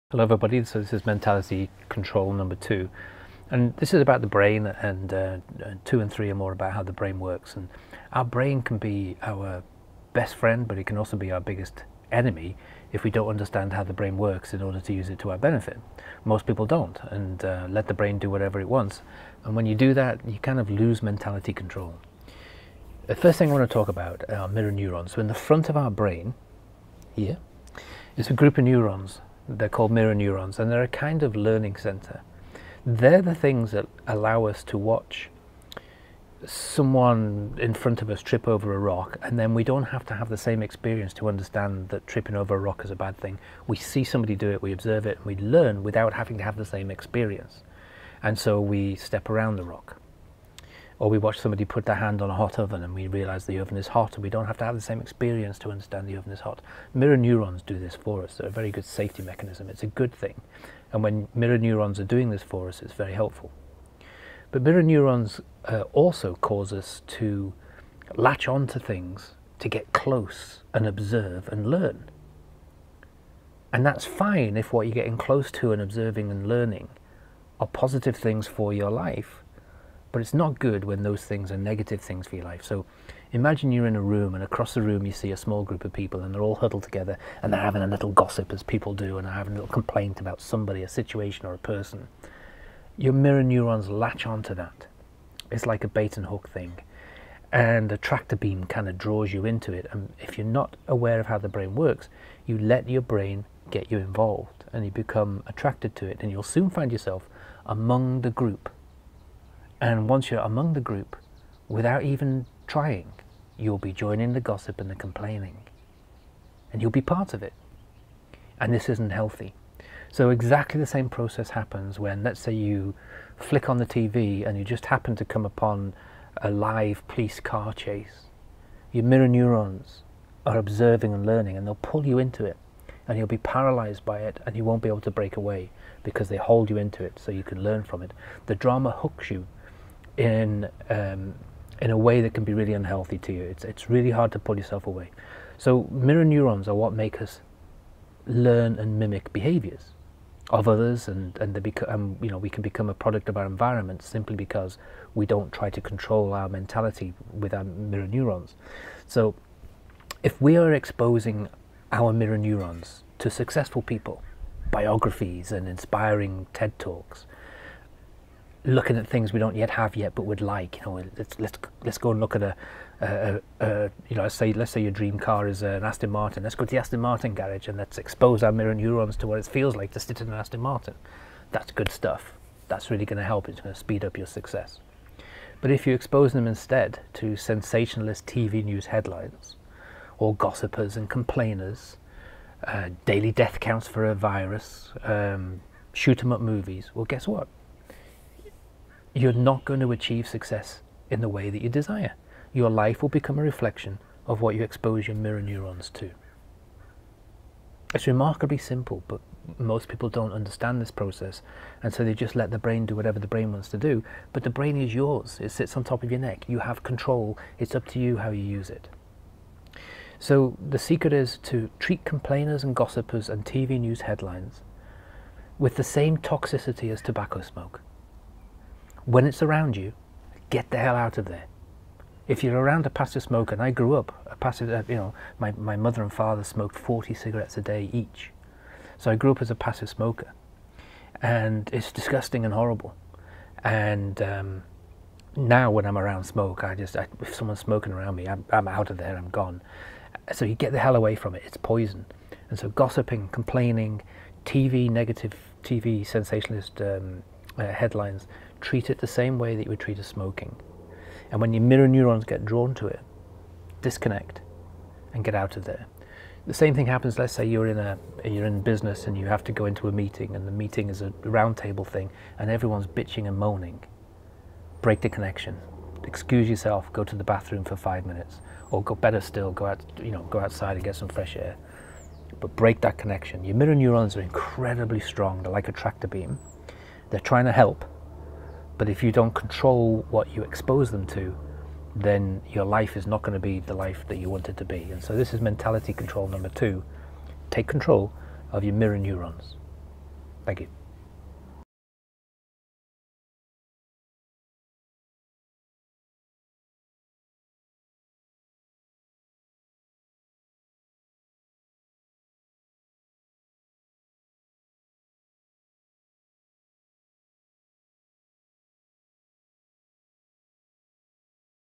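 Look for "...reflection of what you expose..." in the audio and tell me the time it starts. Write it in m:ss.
3:23.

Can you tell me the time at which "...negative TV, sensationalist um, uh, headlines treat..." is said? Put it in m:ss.
4:14.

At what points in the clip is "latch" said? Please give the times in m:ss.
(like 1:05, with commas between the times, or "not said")
1:08, 1:33.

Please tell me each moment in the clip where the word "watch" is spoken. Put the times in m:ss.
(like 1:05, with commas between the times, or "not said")
0:34, 0:51.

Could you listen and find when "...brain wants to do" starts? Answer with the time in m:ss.
3:33.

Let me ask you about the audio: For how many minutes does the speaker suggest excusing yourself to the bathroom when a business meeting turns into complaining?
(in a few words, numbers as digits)
5.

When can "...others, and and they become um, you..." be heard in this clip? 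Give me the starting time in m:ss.
2:30.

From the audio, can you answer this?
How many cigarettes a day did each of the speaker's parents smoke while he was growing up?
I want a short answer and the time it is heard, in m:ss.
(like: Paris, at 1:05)
40, at 3:56.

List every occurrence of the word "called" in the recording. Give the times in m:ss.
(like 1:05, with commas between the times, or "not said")
0:29.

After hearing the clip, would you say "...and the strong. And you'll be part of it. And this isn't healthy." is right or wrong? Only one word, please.
wrong.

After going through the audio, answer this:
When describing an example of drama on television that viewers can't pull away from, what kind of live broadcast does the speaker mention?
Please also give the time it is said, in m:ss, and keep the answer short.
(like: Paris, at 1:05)
Police car chase, at 2:07.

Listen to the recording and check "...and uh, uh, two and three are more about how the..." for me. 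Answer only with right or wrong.
right.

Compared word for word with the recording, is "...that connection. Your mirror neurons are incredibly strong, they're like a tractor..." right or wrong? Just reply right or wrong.
right.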